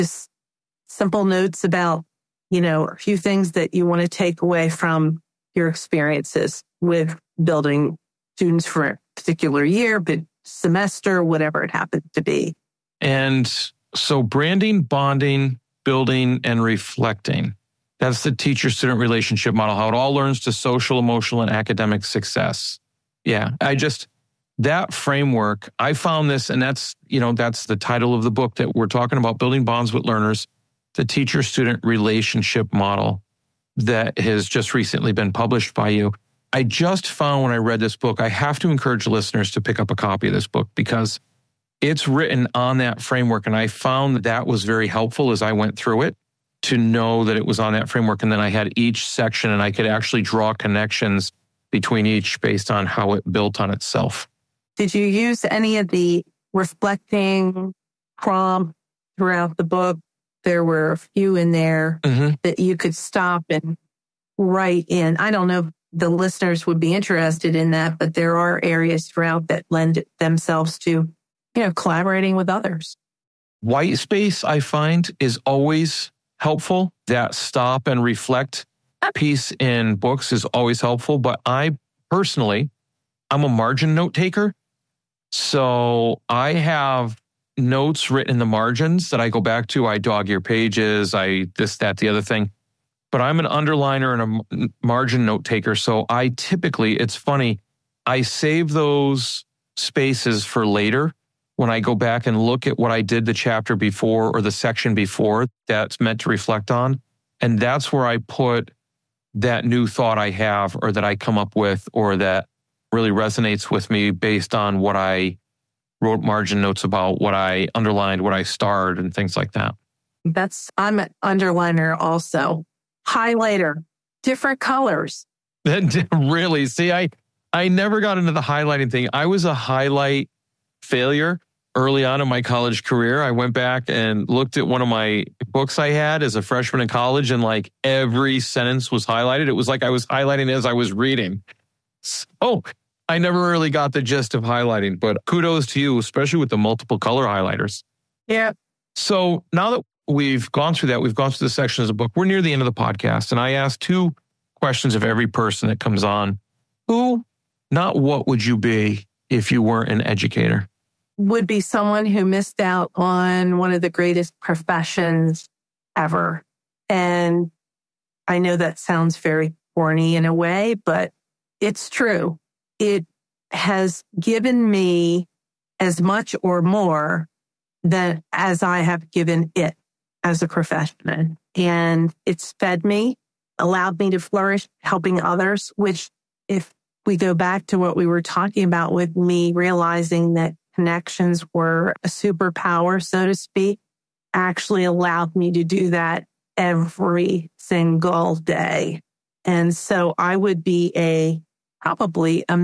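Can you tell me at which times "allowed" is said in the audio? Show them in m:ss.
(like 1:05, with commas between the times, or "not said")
3:03, 3:14.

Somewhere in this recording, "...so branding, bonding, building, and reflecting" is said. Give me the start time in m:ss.
0:13.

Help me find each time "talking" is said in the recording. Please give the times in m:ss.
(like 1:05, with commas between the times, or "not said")
0:28, 3:08.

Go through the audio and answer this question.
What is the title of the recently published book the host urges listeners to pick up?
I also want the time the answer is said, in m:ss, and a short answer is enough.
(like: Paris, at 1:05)
Building Bonds with Learners, at 0:29.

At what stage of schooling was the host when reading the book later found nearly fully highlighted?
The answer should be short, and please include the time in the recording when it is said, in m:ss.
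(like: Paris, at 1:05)
Freshman in college, at 2:16.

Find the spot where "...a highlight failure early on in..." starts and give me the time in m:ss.
2:09.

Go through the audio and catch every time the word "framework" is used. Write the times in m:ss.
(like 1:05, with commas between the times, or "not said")
0:24, 0:43, 0:47.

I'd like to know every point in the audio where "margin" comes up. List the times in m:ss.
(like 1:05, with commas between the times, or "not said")
1:23, 1:28, 1:34, 1:56.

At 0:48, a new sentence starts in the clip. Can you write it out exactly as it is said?
And then I had each section and I could actually draw connections between each based on how it built on itself.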